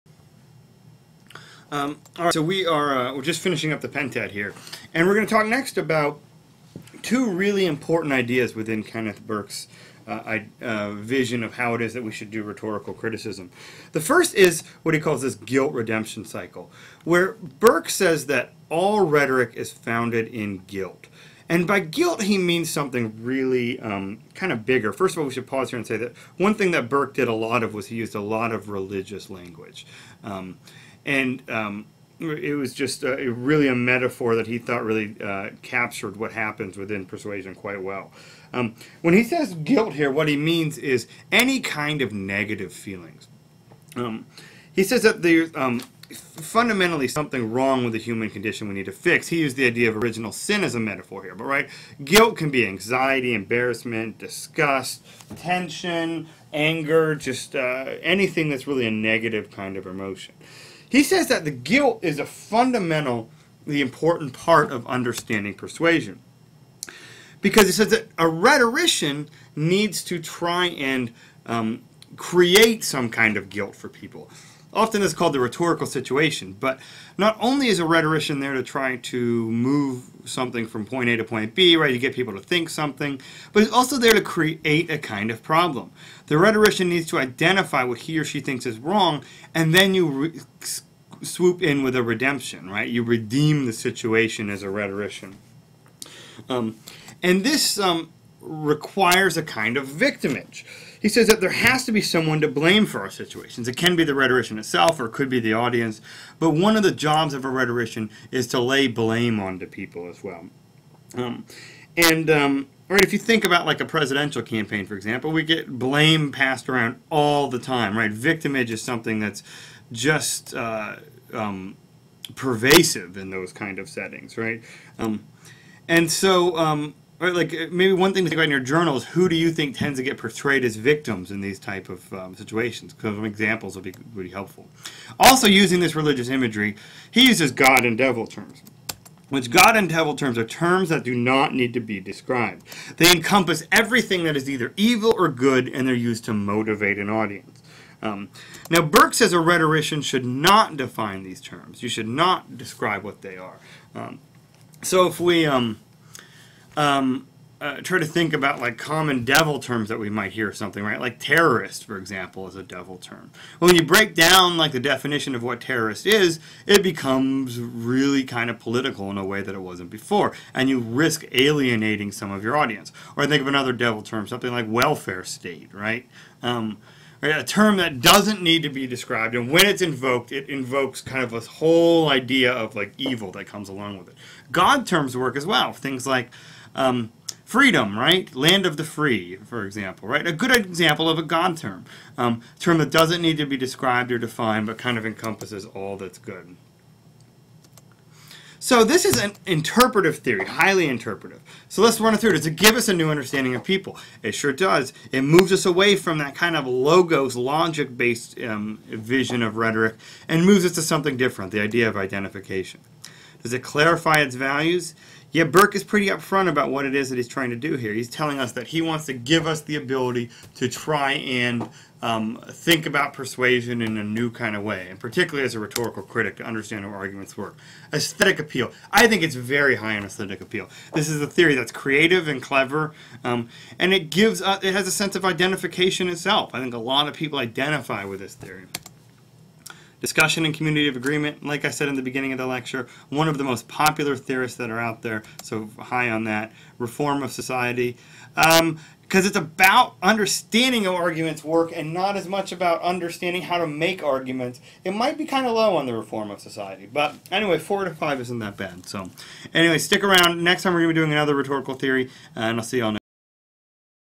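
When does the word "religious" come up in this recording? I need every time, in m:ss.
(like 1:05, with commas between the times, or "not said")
0:28, 2:15.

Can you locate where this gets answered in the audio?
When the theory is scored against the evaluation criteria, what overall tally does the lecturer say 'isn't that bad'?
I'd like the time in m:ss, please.
4:17.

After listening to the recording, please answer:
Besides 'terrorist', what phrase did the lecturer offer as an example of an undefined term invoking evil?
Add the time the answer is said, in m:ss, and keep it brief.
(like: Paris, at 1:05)
Welfare state, at 2:54.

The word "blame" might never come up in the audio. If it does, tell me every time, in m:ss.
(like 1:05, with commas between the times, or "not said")
1:42, 1:48, 1:55.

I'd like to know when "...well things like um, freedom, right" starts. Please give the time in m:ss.
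3:05.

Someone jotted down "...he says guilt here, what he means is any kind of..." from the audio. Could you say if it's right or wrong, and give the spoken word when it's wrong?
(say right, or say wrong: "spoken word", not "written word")
right.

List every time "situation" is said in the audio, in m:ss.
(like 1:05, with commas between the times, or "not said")
1:15, 1:33, 1:43, 2:12.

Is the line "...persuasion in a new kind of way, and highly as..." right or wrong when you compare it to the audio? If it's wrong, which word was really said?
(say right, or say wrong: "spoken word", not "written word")
wrong: "particularly", not "highly".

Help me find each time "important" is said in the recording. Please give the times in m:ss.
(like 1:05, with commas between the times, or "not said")
0:07, 1:03.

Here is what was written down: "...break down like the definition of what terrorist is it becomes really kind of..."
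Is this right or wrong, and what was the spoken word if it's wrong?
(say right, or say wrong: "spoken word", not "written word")
right.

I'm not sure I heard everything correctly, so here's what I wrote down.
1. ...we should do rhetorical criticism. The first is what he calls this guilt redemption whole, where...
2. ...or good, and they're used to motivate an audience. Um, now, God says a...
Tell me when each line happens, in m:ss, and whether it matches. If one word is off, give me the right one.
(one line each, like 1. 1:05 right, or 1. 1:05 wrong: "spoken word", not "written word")
1. 0:12 wrong: "cycle", not "whole"
2. 2:25 wrong: "Burke", not "God".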